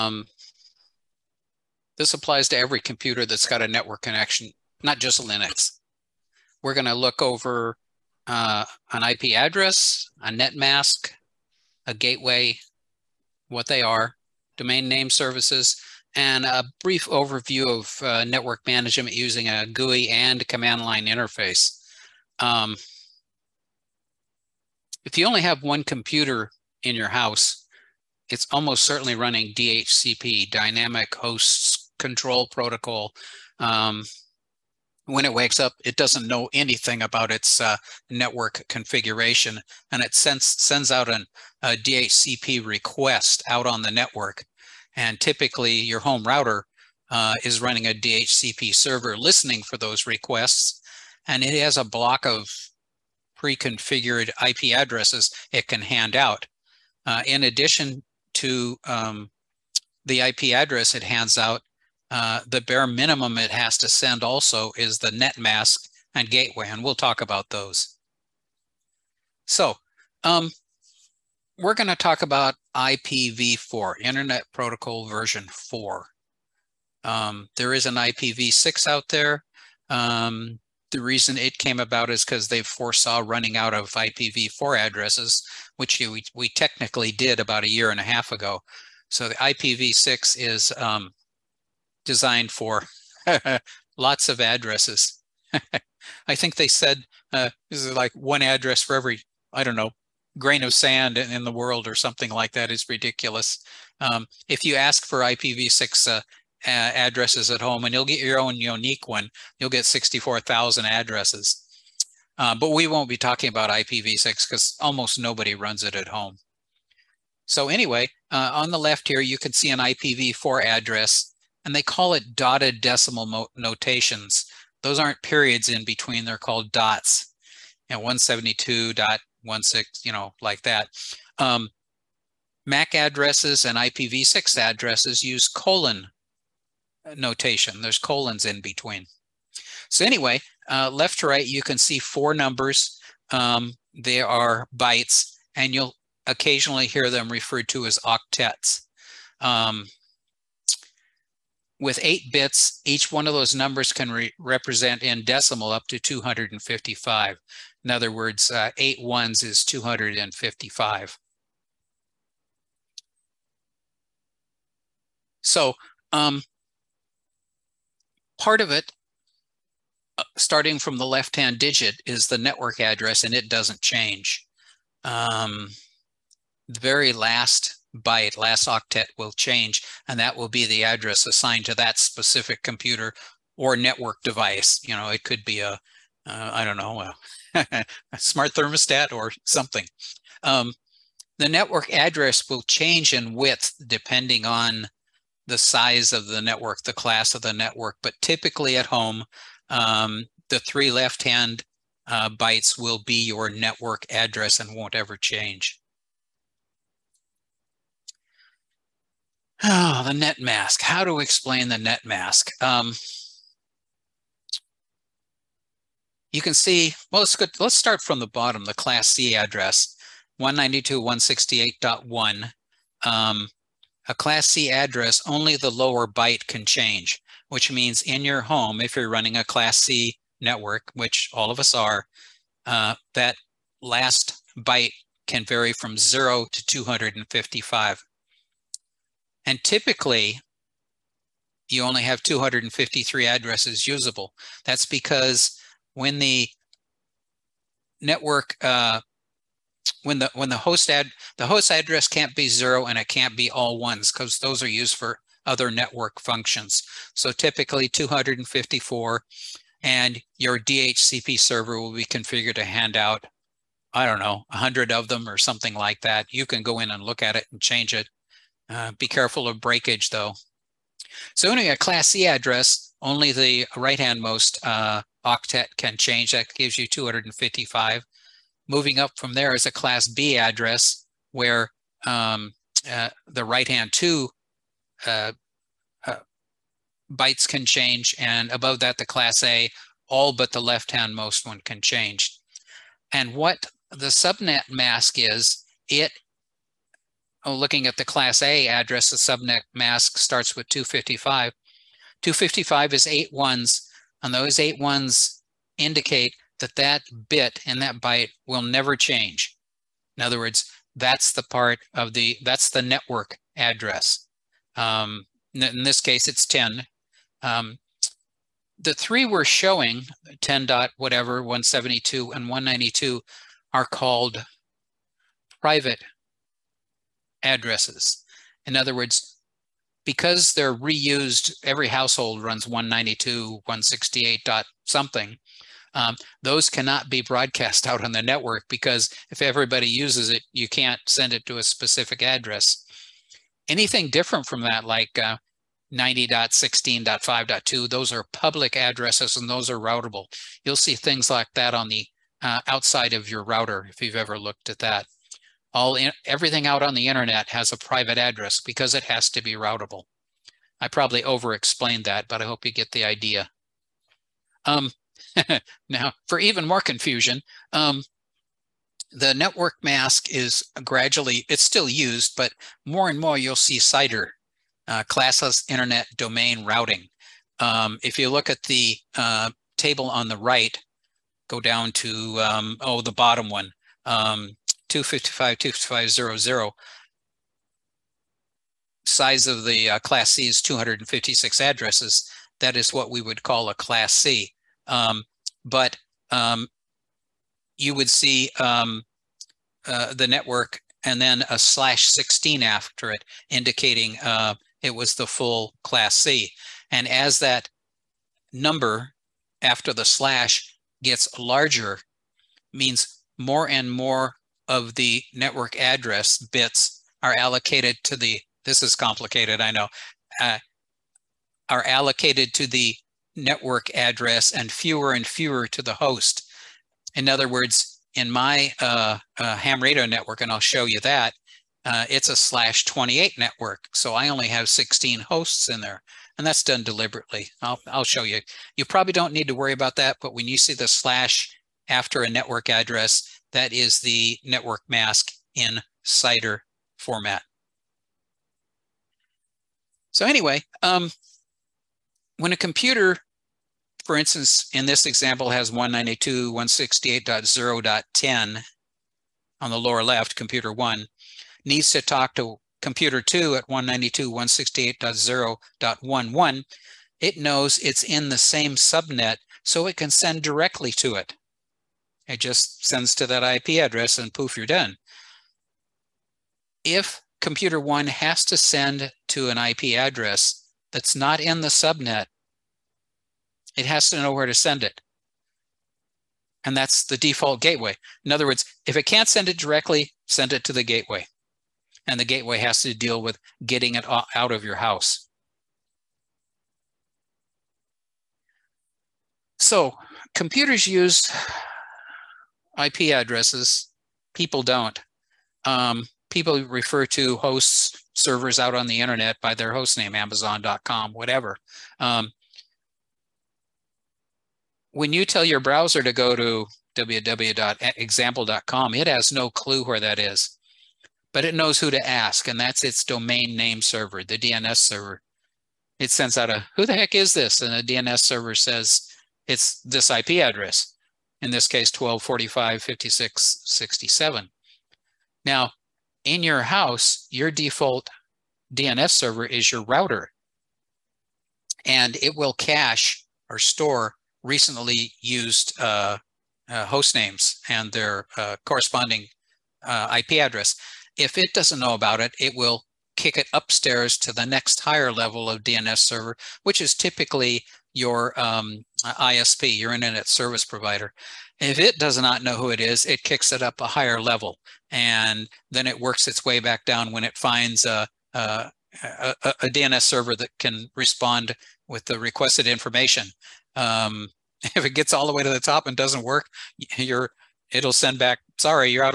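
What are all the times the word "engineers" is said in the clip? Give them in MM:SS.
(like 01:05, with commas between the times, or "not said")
not said.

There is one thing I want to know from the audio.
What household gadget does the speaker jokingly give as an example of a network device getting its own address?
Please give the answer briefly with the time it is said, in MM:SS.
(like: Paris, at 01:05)
smart thermostat, at 03:08.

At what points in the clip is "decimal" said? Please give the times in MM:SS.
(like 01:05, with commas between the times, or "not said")
02:02, 02:35.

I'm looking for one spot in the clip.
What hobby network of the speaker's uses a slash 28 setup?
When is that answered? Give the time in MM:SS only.
07:09.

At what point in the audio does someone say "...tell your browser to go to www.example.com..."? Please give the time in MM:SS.
08:35.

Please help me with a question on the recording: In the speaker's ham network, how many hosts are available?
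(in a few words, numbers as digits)
16.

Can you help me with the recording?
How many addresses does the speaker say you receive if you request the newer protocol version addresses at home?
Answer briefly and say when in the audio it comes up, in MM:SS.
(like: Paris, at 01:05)
64,000, at 01:49.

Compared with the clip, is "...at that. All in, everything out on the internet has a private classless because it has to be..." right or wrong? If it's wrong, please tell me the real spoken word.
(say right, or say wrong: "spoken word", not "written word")
wrong: "address", not "classless".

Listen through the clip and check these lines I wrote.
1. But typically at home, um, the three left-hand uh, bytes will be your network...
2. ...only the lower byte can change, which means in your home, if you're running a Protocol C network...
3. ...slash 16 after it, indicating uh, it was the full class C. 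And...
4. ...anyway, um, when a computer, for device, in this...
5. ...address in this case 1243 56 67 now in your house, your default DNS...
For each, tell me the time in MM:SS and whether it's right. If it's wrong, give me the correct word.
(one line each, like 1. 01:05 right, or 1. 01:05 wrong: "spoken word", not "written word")
1. 03:18 right
2. 03:45 wrong: "Class", not "Protocol"
3. 06:41 right
4. 07:30 wrong: "instance", not "device"
5. 08:50 wrong: "1245", not "1243".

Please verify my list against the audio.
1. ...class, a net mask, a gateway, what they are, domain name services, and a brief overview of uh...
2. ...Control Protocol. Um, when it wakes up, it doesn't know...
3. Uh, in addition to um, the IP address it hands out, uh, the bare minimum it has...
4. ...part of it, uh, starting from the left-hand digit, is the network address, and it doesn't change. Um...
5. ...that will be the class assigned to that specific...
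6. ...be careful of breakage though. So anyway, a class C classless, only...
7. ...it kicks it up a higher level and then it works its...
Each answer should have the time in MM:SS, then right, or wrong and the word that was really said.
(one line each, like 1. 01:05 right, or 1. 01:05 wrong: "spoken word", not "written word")
1. 00:09 wrong: "address", not "class"
2. 00:31 right
3. 00:57 right
4. 02:48 right
5. 03:00 wrong: "address", not "class"
6. 04:28 wrong: "address", not "classless"
7. 09:23 right.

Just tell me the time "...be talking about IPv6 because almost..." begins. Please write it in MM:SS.
01:53.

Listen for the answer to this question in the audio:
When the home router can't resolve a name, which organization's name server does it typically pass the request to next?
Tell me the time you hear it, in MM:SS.
09:19.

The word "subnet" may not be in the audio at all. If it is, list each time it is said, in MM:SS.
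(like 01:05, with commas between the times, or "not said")
04:54, 04:59, 07:48, 08:01.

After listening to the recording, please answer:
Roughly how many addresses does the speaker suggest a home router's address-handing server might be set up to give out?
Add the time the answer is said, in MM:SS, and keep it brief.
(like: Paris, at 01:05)
100, at 04:24.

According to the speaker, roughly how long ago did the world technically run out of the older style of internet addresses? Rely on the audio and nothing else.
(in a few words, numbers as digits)
a year and a half ago.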